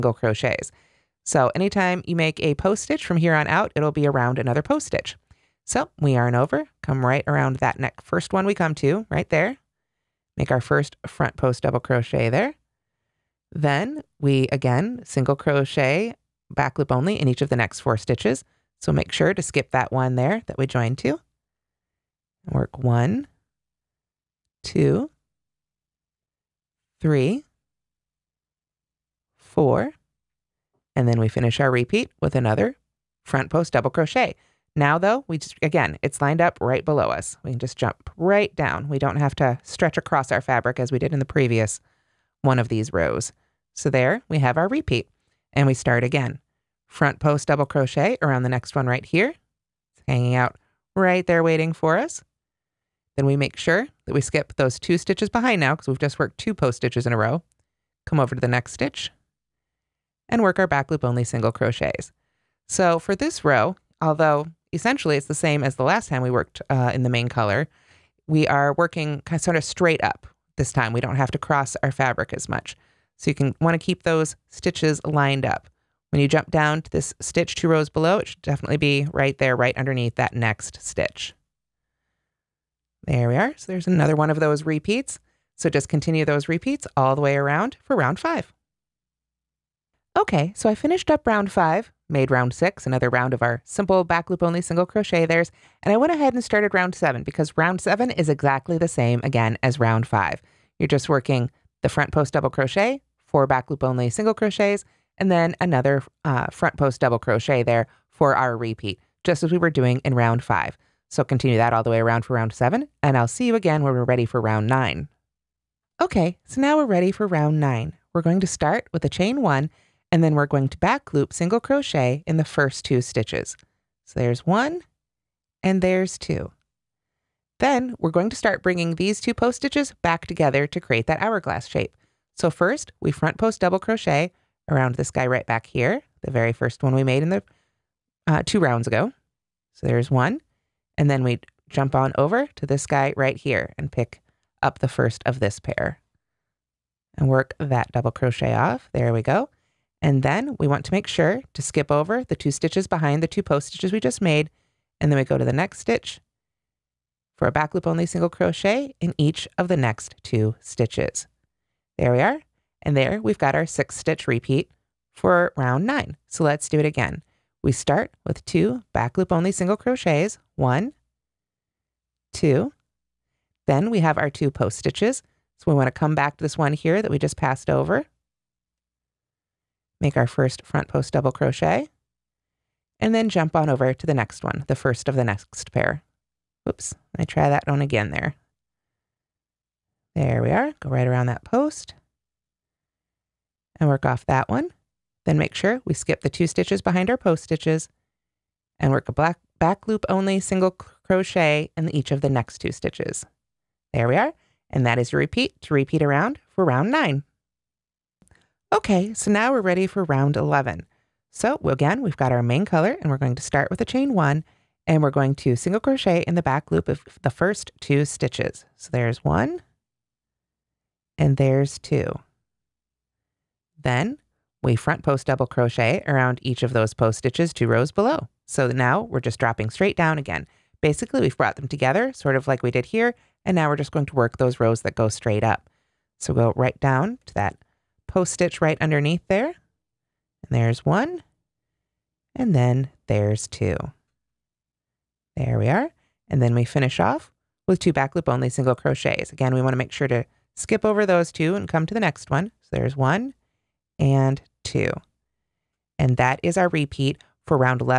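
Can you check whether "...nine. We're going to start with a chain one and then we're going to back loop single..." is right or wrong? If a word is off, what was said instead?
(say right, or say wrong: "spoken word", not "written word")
right.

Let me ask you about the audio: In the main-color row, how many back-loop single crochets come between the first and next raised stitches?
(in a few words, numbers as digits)
4.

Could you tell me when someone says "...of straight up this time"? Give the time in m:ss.
1:09.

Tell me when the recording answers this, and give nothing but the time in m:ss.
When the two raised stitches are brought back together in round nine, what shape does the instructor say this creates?
2:11.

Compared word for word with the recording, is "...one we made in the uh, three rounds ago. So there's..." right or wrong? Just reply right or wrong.
wrong.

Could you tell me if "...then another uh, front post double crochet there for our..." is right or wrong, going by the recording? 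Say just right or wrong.
right.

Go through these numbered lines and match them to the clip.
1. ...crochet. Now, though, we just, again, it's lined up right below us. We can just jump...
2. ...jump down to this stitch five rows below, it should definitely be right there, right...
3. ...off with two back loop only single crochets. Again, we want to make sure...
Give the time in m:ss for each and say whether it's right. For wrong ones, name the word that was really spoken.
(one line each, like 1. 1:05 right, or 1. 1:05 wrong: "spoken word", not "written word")
1. 0:33 right
2. 1:16 wrong: "two", not "five"
3. 4:06 right.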